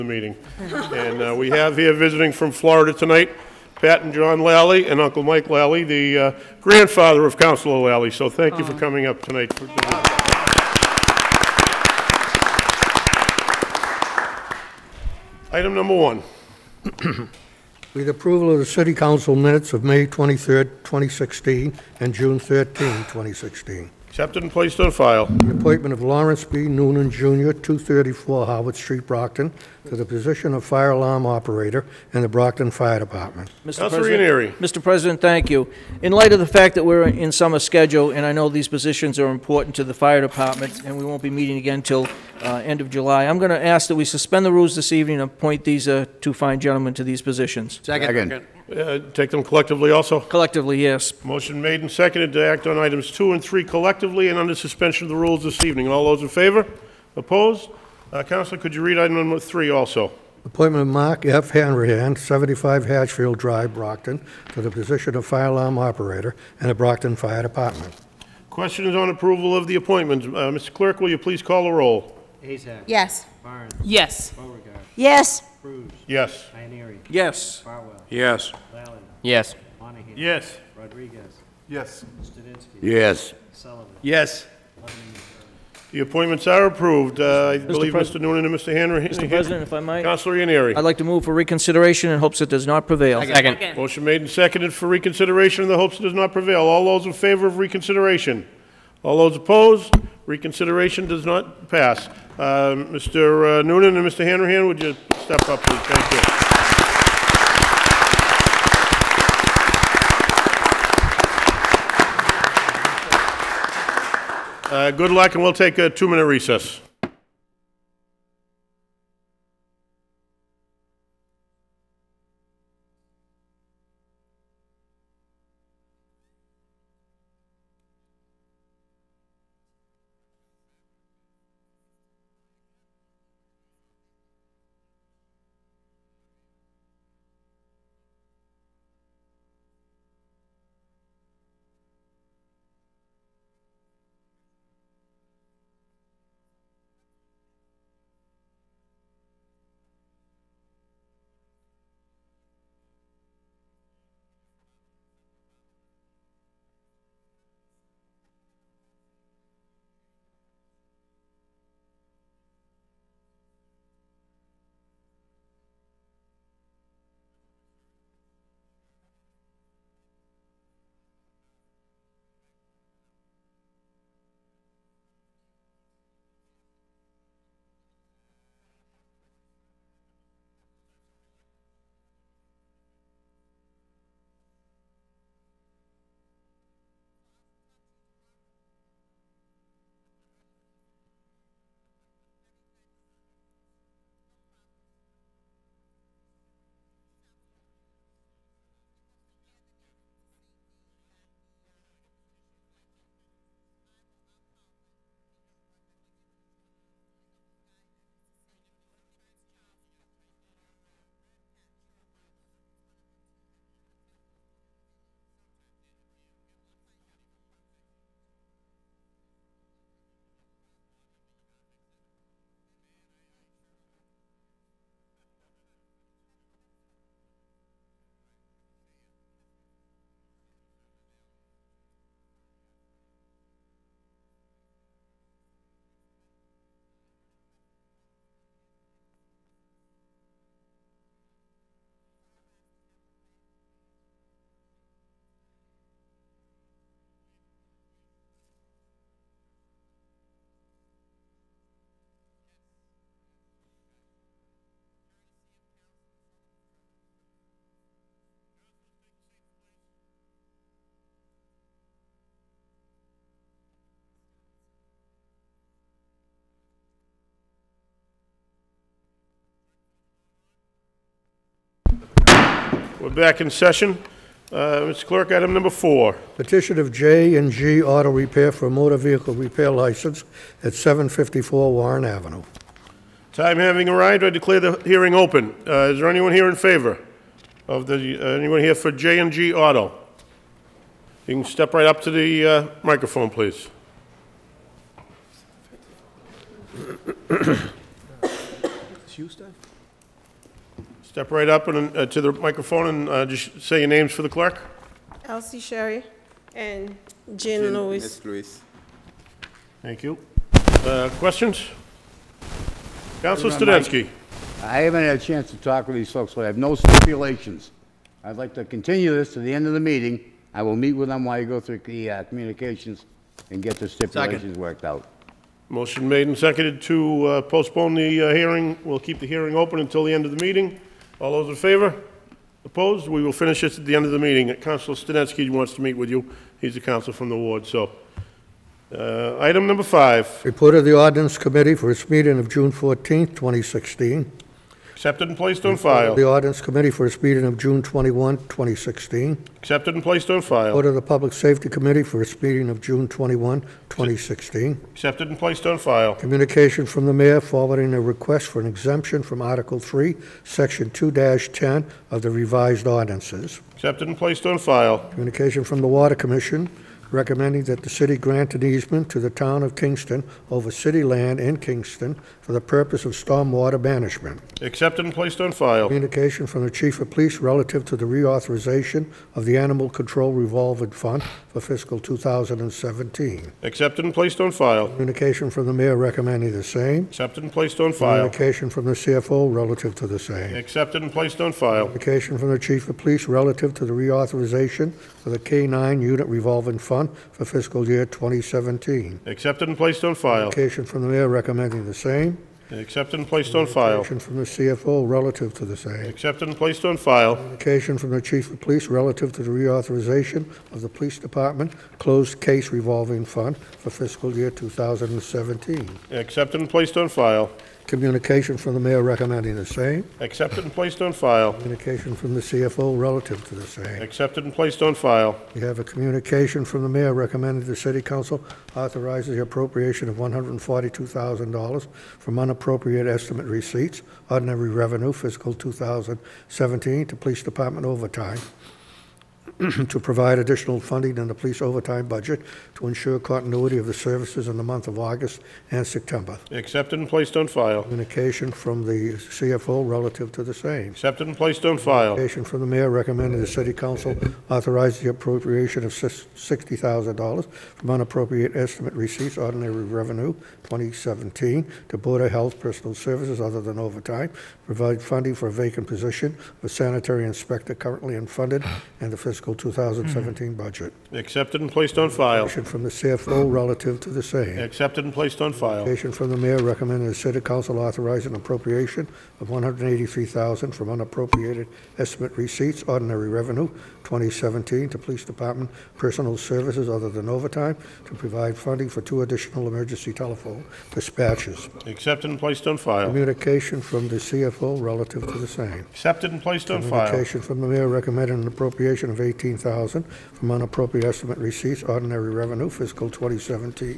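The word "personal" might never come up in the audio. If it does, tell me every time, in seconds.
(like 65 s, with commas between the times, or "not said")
462 s, 485 s.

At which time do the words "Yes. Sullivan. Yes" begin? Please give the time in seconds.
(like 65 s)
82 s.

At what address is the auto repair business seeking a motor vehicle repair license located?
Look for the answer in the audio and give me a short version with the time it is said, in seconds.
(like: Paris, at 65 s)
754 Warren Avenue, at 280 s.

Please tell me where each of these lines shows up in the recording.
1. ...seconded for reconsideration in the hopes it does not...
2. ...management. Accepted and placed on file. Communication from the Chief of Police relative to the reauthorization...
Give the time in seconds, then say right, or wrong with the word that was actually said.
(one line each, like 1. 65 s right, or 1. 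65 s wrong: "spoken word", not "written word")
1. 94 s right
2. 373 s right.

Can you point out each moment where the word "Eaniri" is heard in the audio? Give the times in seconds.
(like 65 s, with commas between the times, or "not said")
76 s, 90 s.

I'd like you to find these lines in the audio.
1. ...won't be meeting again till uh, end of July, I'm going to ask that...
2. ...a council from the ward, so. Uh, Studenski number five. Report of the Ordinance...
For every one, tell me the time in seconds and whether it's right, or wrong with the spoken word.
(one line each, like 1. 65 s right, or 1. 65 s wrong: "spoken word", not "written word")
1. 41 s right
2. 336 s wrong: "Item", not "Studenski".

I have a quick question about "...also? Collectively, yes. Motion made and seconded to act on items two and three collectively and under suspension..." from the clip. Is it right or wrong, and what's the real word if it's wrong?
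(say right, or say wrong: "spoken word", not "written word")
right.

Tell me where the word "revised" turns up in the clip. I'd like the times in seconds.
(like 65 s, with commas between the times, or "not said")
362 s.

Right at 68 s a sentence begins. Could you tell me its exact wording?
Questions on approval of the appointment.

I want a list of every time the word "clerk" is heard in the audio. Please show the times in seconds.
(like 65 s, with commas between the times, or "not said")
70 s, 275 s, 304 s.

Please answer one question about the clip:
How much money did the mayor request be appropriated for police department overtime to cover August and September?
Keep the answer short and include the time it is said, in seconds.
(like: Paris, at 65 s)
$142,000, at 430 s.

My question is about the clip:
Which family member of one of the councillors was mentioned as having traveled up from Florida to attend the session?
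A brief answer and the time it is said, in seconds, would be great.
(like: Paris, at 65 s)
Uncle Mike Lally, at 4 s.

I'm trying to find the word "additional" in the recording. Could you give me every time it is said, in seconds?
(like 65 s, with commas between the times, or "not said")
440 s, 489 s.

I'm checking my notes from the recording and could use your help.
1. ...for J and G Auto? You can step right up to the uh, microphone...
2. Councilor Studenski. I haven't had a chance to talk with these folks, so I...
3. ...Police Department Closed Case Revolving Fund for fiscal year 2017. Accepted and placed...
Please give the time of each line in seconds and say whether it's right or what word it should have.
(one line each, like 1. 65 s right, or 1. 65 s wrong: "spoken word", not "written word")
1. 288 s right
2. 313 s right
3. 410 s right.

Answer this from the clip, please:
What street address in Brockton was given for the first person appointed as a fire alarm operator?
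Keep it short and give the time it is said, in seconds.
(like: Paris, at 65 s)
234 Howard Street, at 27 s.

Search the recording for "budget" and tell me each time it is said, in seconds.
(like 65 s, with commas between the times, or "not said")
442 s, 470 s.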